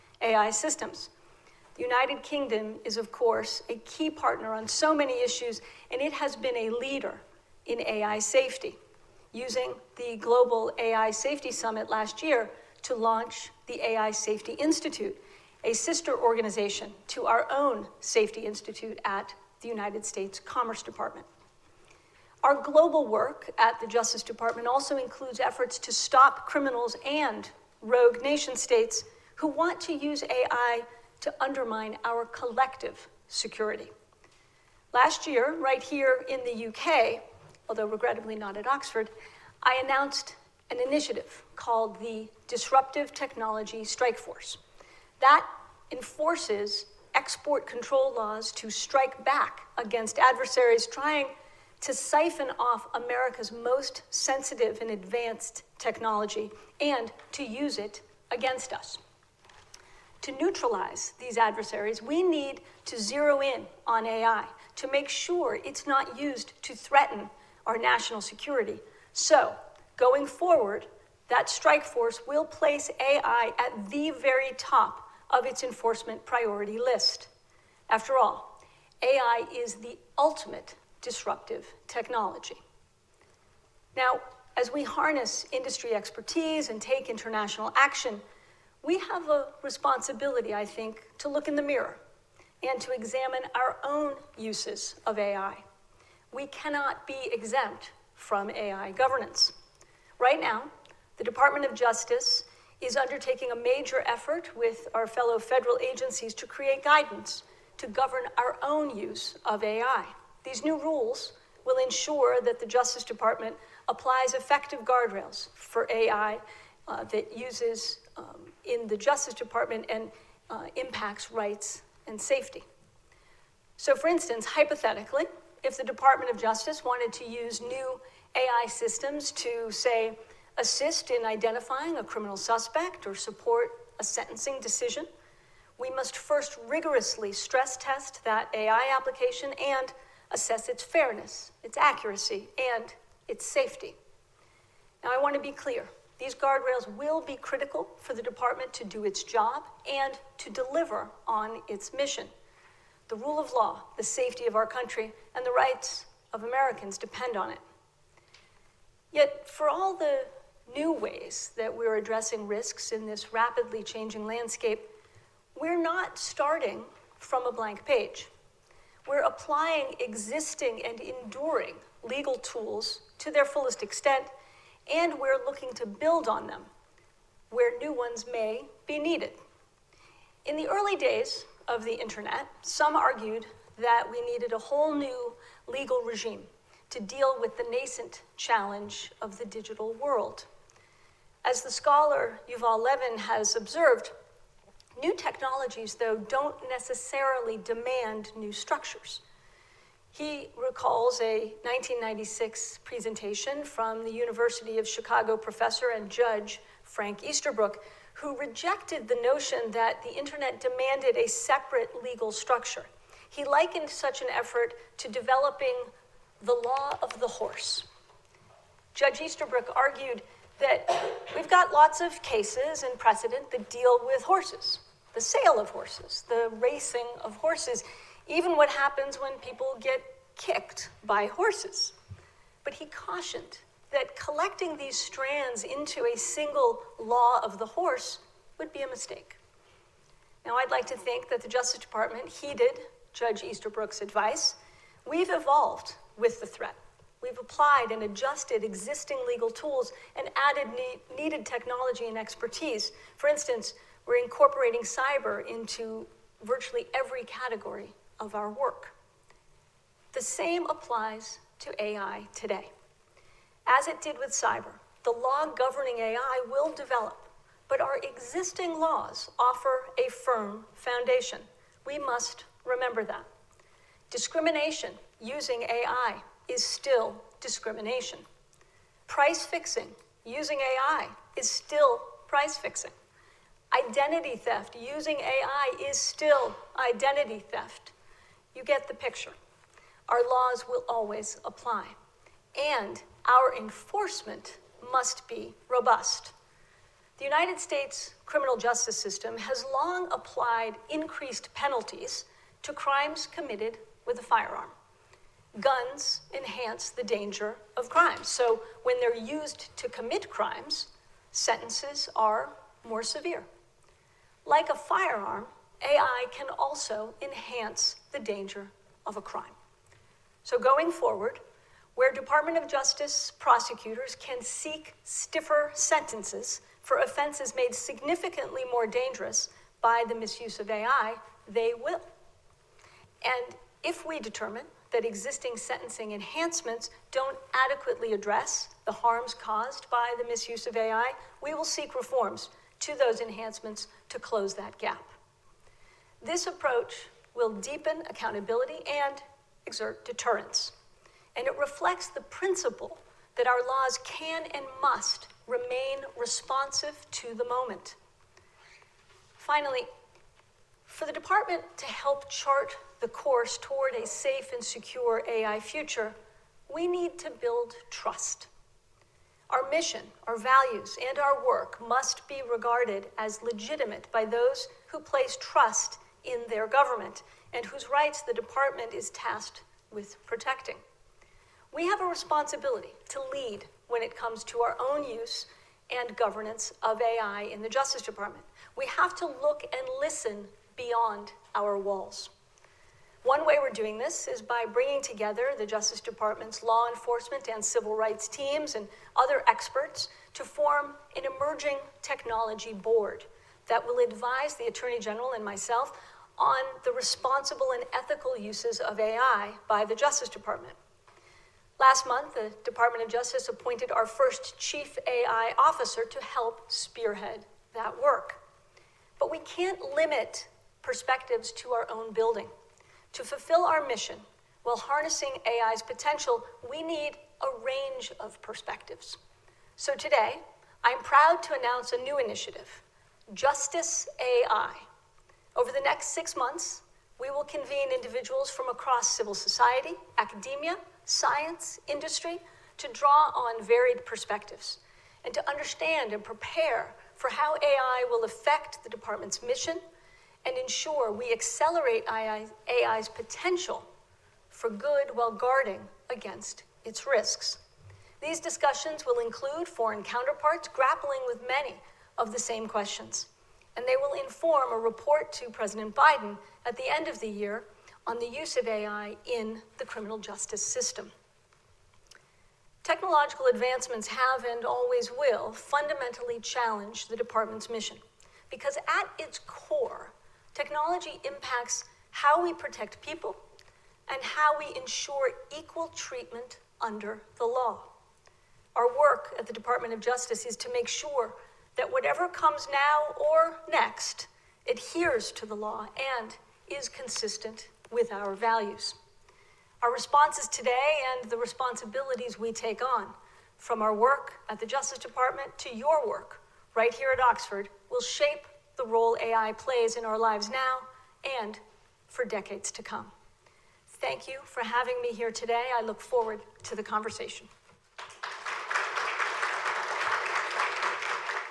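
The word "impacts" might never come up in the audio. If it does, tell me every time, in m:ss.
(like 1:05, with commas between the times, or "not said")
2:00, 8:01.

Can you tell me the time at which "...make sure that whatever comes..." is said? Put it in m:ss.
8:10.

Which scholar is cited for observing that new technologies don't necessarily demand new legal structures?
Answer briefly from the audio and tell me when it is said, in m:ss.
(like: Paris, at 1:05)
Yuval Levin, at 3:12.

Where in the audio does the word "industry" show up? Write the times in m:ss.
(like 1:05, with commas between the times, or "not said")
1:25, 7:21.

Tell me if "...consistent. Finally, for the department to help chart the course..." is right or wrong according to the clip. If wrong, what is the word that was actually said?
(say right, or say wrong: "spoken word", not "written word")
wrong: "moment", not "consistent".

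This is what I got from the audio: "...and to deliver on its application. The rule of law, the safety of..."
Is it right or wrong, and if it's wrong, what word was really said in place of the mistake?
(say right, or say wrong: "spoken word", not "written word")
wrong: "mission", not "application".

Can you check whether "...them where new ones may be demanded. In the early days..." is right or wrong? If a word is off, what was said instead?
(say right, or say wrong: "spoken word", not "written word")
wrong: "needed", not "demanded".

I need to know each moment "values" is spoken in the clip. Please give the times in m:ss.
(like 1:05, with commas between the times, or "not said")
6:10, 8:18.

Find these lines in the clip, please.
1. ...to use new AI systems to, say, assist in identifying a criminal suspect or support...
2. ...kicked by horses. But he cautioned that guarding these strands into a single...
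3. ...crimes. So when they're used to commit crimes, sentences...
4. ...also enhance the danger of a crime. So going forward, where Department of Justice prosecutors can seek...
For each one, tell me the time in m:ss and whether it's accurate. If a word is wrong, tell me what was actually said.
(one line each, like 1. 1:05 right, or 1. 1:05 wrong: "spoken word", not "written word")
1. 2:07 right
2. 3:50 wrong: "collecting", not "guarding"
3. 5:07 right
4. 5:16 right.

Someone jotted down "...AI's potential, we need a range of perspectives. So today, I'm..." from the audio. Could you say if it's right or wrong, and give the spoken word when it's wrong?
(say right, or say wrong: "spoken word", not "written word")
right.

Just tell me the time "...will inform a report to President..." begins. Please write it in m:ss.
7:43.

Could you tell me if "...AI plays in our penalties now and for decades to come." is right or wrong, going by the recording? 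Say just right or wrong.
wrong.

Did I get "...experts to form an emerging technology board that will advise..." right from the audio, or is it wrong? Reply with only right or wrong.
right.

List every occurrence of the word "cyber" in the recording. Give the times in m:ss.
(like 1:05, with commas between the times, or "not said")
4:14, 4:24.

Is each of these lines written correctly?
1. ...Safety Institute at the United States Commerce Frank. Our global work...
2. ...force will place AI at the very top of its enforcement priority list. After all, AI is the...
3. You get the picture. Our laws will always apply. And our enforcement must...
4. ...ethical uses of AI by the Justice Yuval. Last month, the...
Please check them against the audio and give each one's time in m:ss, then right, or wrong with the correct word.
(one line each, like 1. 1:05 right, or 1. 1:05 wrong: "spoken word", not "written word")
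1. 0:17 wrong: "Department", not "Frank"
2. 1:11 right
3. 4:48 right
4. 6:47 wrong: "Department", not "Yuval".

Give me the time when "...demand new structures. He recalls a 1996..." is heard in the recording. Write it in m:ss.
3:17.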